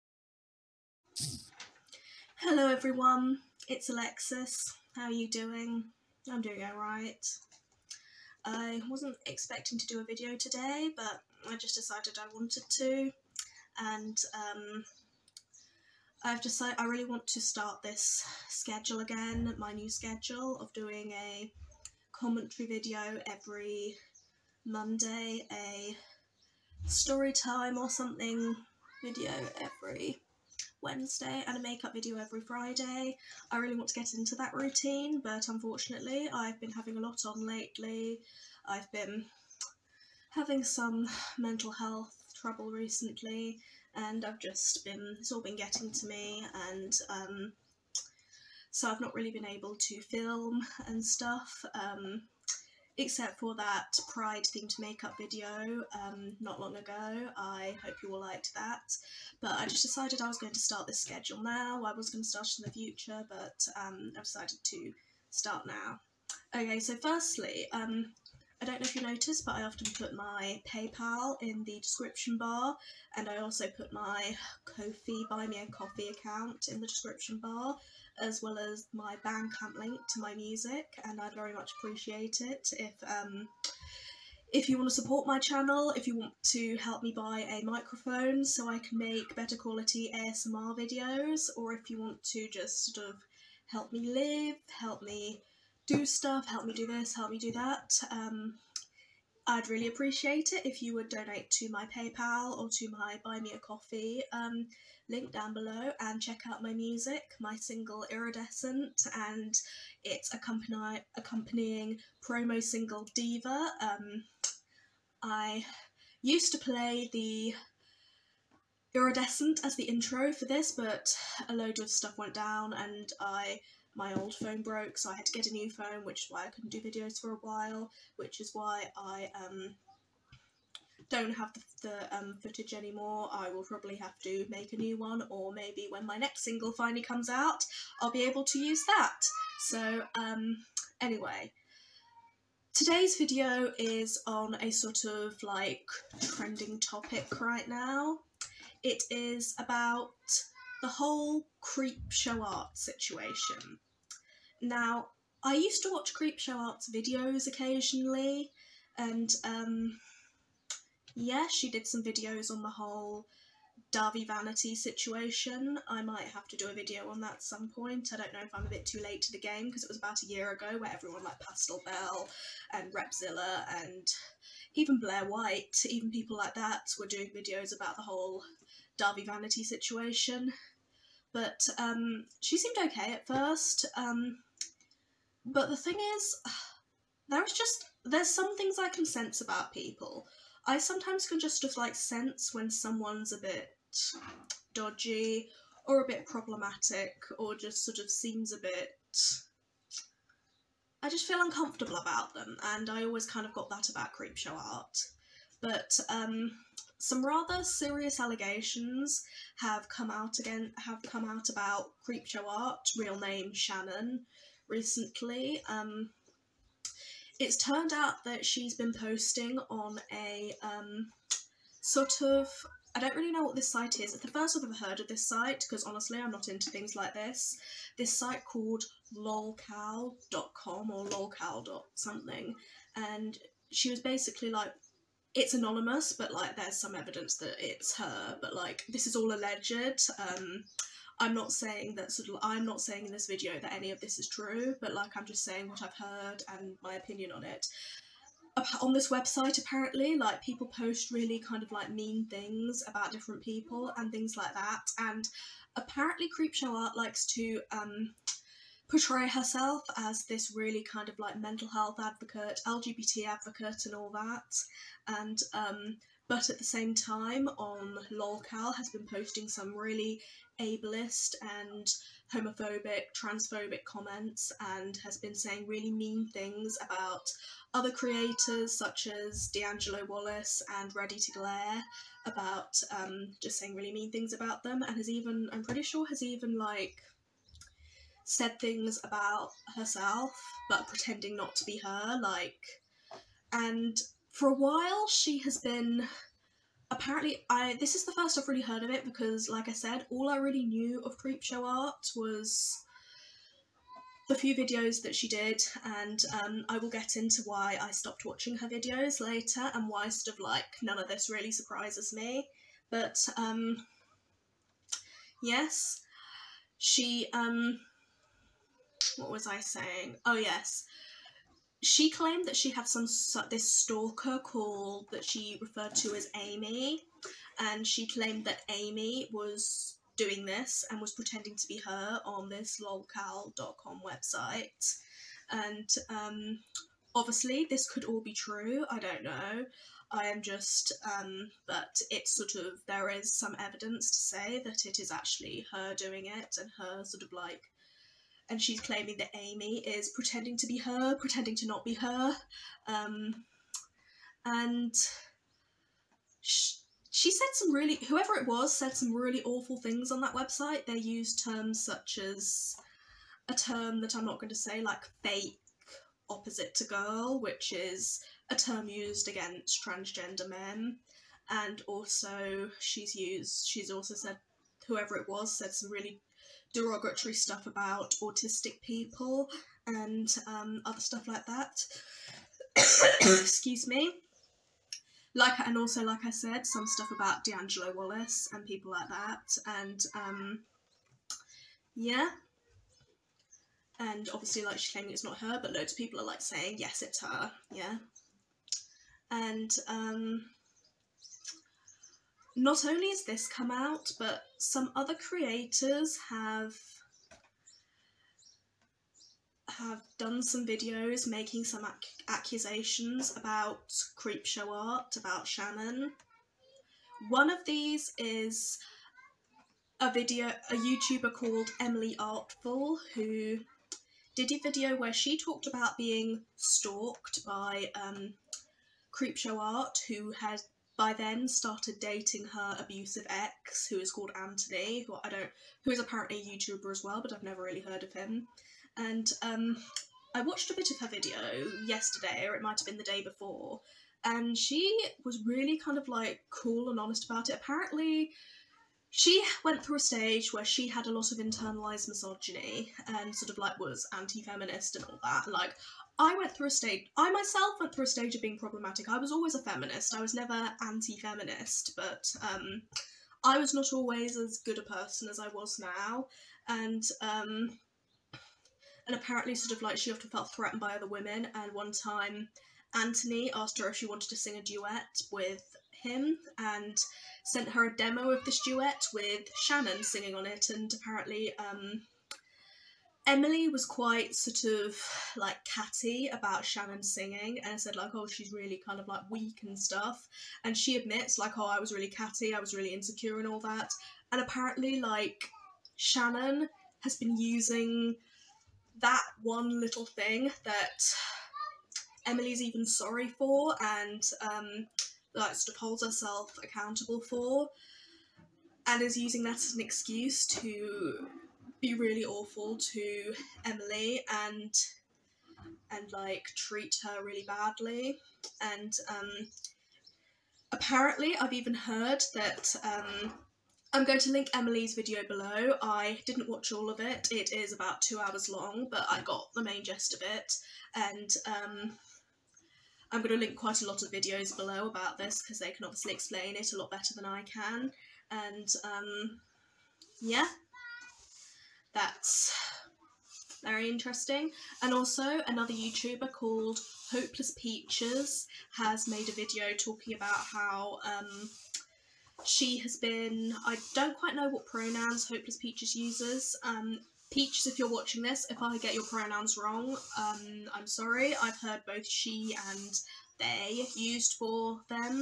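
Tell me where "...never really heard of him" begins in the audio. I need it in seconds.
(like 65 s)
437 s.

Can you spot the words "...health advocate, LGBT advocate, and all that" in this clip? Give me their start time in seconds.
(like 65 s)
261 s.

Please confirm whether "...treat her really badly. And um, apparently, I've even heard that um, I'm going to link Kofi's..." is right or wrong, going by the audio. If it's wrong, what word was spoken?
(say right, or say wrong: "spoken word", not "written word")
wrong: "Emily", not "Kofi".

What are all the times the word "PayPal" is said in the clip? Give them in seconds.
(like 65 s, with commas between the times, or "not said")
70 s, 101 s.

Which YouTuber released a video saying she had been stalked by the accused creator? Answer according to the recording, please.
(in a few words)
Emily Artful.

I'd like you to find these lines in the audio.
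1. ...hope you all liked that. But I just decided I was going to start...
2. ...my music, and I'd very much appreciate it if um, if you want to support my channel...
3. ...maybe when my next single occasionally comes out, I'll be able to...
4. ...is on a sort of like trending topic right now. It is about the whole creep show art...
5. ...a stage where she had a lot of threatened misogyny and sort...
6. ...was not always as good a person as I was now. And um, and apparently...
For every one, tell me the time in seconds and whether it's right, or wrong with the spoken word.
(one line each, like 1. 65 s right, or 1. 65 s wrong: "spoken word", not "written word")
1. 57 s right
2. 80 s right
3. 135 s wrong: "finally", not "occasionally"
4. 143 s right
5. 449 s wrong: "internalized", not "threatened"
6. 463 s right.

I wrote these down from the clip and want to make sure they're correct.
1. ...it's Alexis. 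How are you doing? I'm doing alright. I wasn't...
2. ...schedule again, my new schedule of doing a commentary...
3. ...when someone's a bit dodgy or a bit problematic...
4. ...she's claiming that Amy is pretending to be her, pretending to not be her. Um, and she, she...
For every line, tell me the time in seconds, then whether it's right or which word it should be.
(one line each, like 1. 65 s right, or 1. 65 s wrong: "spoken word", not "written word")
1. 3 s right
2. 18 s right
3. 192 s right
4. 348 s right.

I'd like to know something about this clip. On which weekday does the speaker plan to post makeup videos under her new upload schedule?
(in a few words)
Friday.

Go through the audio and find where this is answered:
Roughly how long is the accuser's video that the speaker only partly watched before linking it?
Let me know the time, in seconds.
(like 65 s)
528 s.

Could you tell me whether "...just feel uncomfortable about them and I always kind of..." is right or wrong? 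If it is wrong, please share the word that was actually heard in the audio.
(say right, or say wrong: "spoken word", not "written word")
right.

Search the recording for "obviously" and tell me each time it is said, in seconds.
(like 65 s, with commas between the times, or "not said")
337 s, 394 s, 535 s.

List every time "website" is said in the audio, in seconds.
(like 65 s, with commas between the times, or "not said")
249 s, 334 s, 360 s.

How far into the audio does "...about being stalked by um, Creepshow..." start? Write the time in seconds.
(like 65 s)
425 s.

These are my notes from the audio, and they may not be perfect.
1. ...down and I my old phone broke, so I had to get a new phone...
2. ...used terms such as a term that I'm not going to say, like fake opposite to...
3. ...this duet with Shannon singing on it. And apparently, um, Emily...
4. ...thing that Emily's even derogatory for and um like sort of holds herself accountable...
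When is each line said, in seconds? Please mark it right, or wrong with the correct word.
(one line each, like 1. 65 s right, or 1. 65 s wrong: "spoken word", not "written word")
1. 122 s right
2. 360 s right
3. 478 s right
4. 500 s wrong: "sorry", not "derogatory".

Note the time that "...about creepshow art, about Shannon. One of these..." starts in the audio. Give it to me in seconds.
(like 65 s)
413 s.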